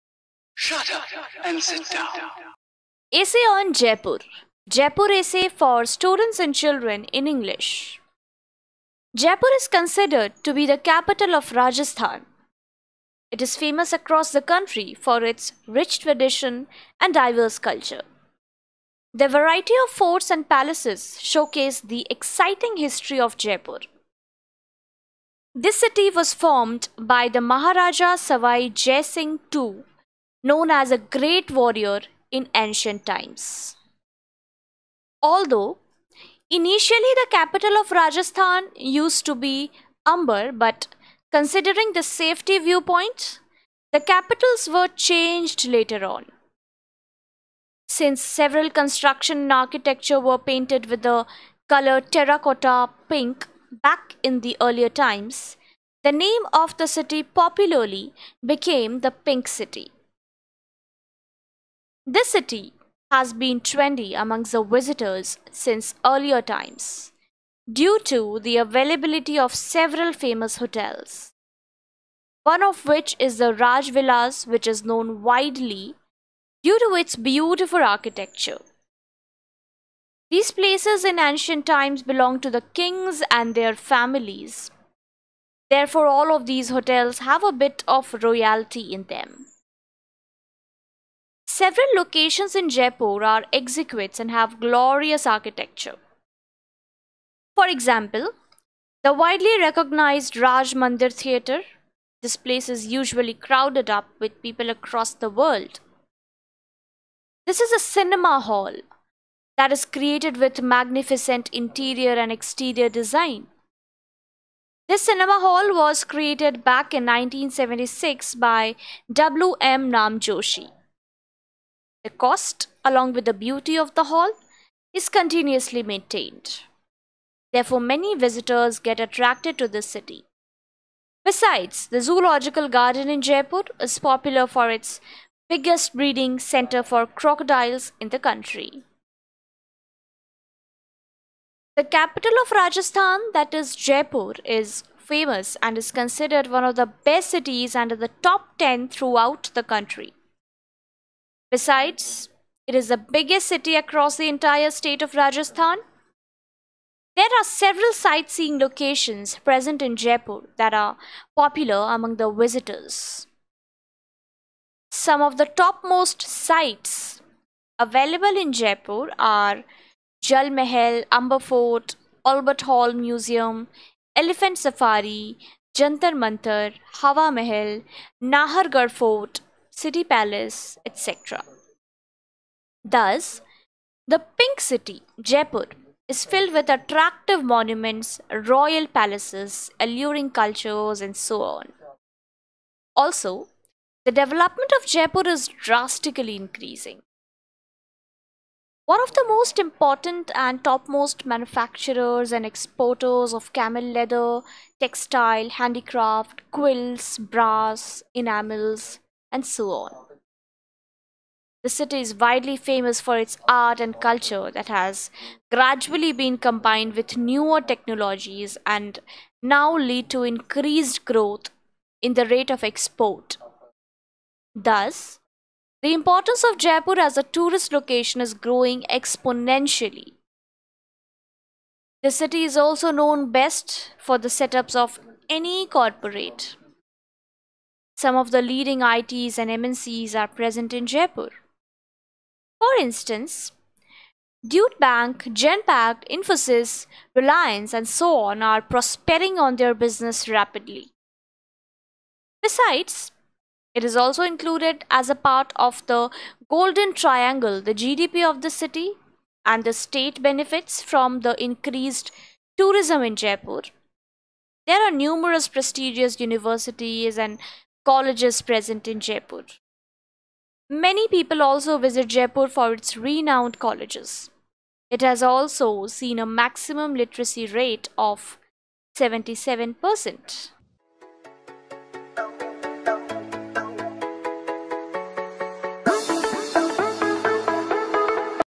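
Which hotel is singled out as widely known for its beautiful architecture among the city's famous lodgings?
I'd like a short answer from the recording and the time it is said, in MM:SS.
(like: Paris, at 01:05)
Rajvilas, at 01:13.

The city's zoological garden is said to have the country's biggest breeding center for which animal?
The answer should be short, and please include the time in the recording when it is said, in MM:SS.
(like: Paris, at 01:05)
crocodiles, at 02:17.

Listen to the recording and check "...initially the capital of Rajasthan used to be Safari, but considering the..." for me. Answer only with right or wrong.
wrong.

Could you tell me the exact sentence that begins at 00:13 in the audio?
It is famous across the country for its rich tradition and diverse culture.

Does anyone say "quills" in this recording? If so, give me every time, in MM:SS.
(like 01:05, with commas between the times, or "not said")
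03:26.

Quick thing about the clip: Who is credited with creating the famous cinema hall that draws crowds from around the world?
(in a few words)
W. M. Namjoshi.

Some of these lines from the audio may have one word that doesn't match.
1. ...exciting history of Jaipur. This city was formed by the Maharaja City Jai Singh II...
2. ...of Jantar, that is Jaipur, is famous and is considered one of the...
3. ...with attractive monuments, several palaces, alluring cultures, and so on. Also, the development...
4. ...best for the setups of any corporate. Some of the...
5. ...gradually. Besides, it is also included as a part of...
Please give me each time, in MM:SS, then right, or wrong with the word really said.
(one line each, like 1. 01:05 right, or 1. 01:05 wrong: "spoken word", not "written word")
1. 00:22 wrong: "Sawai", not "City"
2. 02:22 wrong: "Rajasthan", not "Jantar"
3. 03:06 wrong: "royal", not "several"
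4. 03:53 right
5. 04:10 wrong: "rapidly", not "gradually".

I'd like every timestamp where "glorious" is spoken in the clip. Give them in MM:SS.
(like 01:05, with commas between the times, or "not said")
01:34.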